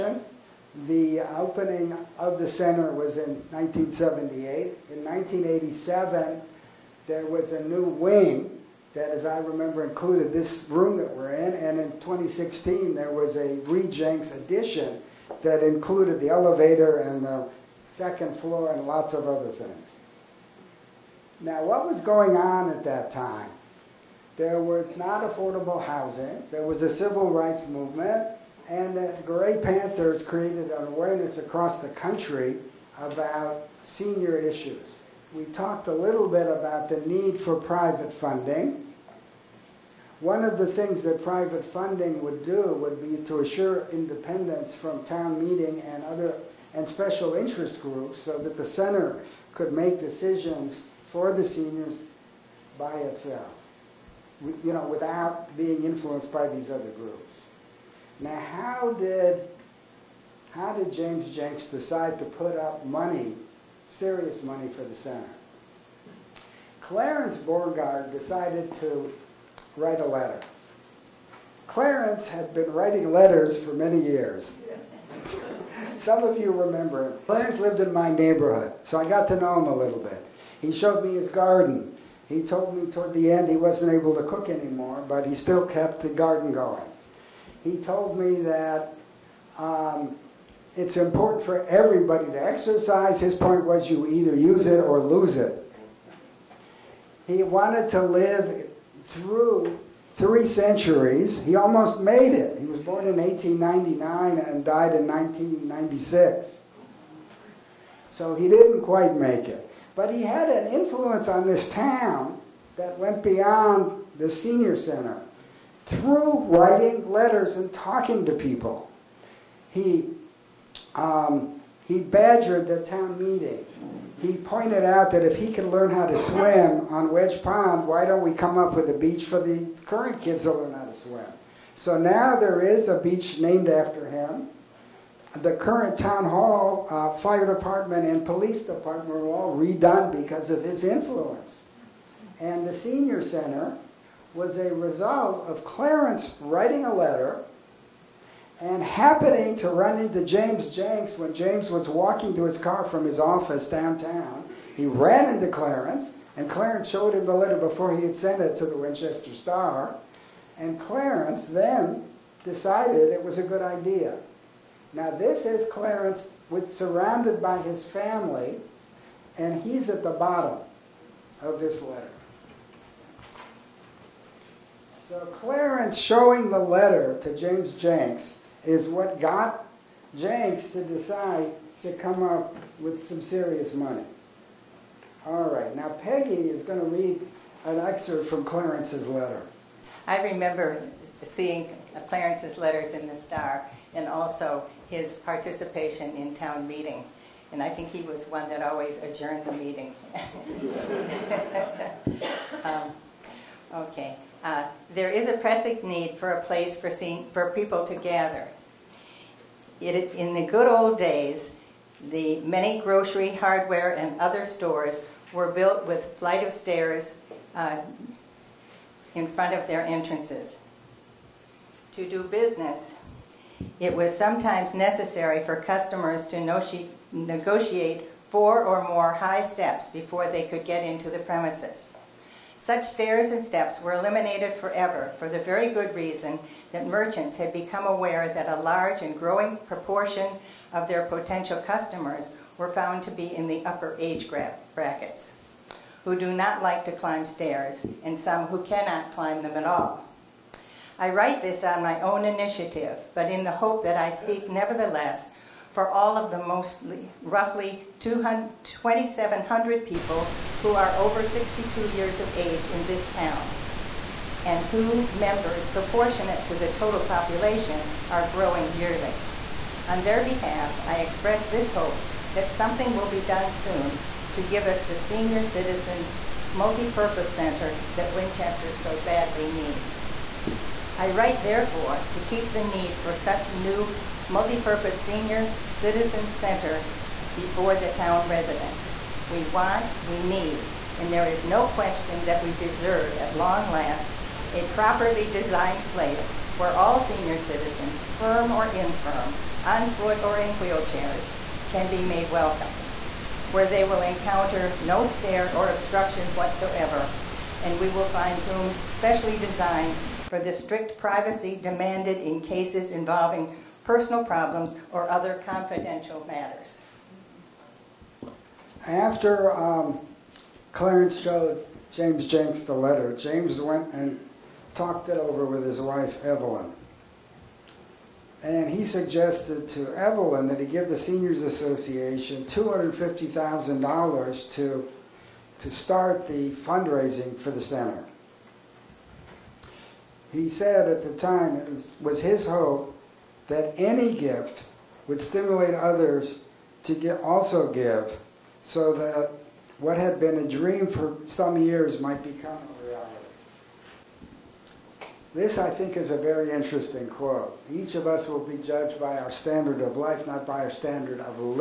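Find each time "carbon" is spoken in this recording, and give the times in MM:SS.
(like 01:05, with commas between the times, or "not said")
not said.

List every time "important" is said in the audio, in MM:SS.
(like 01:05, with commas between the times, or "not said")
01:30.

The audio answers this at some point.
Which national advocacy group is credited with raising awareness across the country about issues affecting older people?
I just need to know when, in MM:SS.
00:29.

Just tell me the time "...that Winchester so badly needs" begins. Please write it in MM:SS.
04:37.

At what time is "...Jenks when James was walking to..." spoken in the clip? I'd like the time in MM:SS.
02:30.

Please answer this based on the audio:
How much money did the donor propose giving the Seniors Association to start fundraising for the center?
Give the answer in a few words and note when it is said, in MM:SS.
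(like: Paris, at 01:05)
$250,000, at 05:32.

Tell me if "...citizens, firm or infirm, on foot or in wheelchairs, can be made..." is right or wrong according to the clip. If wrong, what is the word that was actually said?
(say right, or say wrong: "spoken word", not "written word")
right.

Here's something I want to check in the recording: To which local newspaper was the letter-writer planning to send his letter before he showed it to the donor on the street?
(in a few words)
Winchester Star.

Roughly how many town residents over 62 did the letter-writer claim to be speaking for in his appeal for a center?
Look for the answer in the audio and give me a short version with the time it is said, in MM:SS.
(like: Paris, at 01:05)
2,700, at 04:17.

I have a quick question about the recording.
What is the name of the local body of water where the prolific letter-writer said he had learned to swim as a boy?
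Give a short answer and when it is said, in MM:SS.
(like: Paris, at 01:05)
Wedge Pond, at 02:07.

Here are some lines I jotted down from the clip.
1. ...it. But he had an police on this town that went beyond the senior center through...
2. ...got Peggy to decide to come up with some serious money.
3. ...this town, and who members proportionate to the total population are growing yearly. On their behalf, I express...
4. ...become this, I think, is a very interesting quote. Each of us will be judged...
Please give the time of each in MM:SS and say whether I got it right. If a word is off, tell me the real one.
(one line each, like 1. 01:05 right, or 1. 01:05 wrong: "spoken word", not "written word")
1. 01:49 wrong: "influence", not "police"
2. 02:59 wrong: "Jenks", not "Peggy"
3. 04:22 right
4. 05:52 right.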